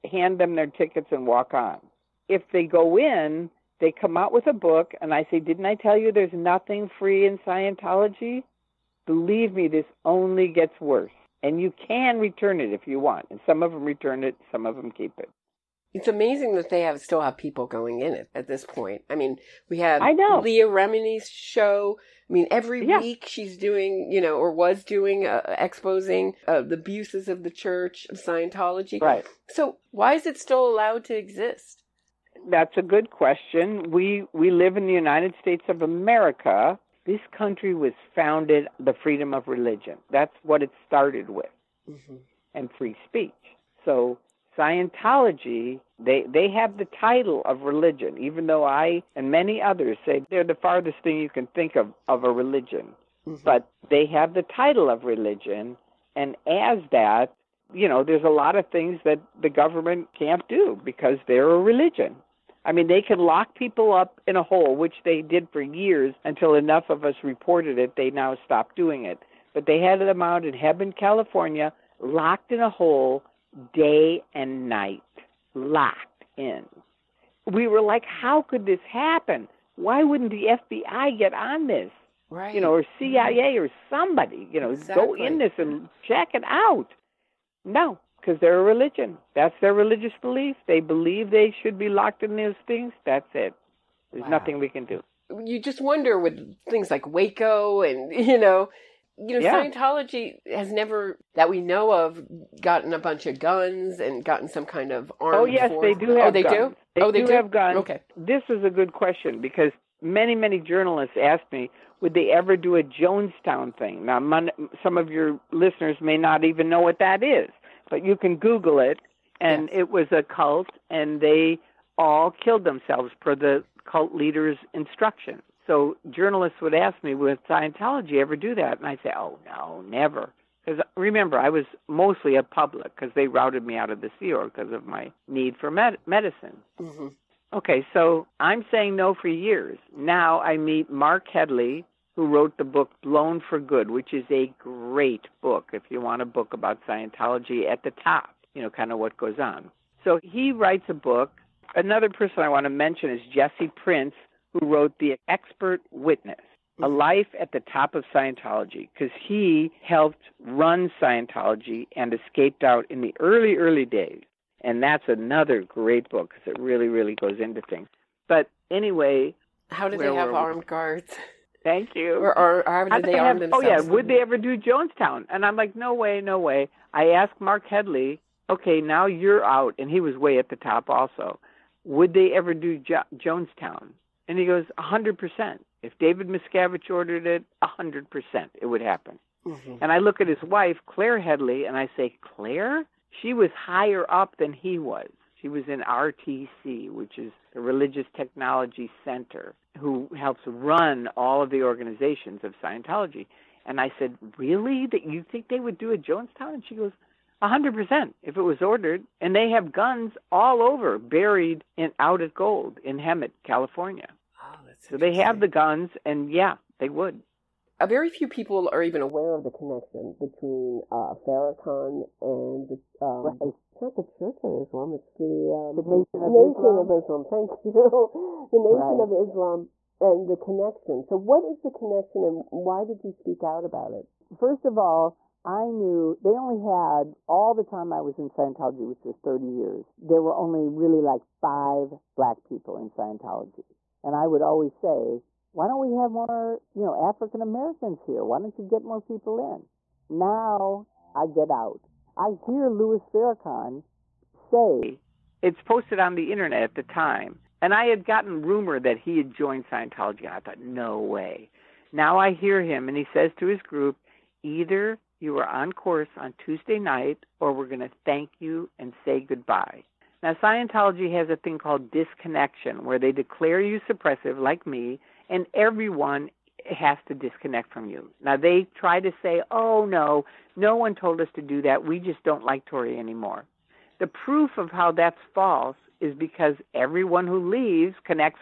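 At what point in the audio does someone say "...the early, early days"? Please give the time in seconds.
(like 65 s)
163 s.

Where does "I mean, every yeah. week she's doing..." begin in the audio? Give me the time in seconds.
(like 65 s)
22 s.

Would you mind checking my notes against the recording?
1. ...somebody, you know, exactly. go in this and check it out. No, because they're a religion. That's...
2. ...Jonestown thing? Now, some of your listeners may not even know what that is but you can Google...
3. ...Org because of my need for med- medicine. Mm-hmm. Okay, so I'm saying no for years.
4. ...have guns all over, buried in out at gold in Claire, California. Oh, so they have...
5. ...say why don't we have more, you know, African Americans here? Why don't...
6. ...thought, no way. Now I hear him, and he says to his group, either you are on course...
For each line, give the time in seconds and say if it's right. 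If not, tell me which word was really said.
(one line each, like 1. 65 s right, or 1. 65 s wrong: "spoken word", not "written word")
1. 83 s right
2. 112 s right
3. 134 s right
4. 209 s wrong: "Hemet", not "Claire"
5. 244 s right
6. 260 s right.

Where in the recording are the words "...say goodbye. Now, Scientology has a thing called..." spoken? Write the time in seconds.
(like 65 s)
269 s.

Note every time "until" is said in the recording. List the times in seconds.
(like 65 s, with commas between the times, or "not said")
66 s.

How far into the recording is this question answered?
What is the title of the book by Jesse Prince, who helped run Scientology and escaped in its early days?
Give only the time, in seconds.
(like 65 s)
154 s.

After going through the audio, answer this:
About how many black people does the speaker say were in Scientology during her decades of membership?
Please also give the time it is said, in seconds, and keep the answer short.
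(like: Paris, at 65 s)
5, at 241 s.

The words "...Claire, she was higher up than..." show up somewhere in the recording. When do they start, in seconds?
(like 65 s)
192 s.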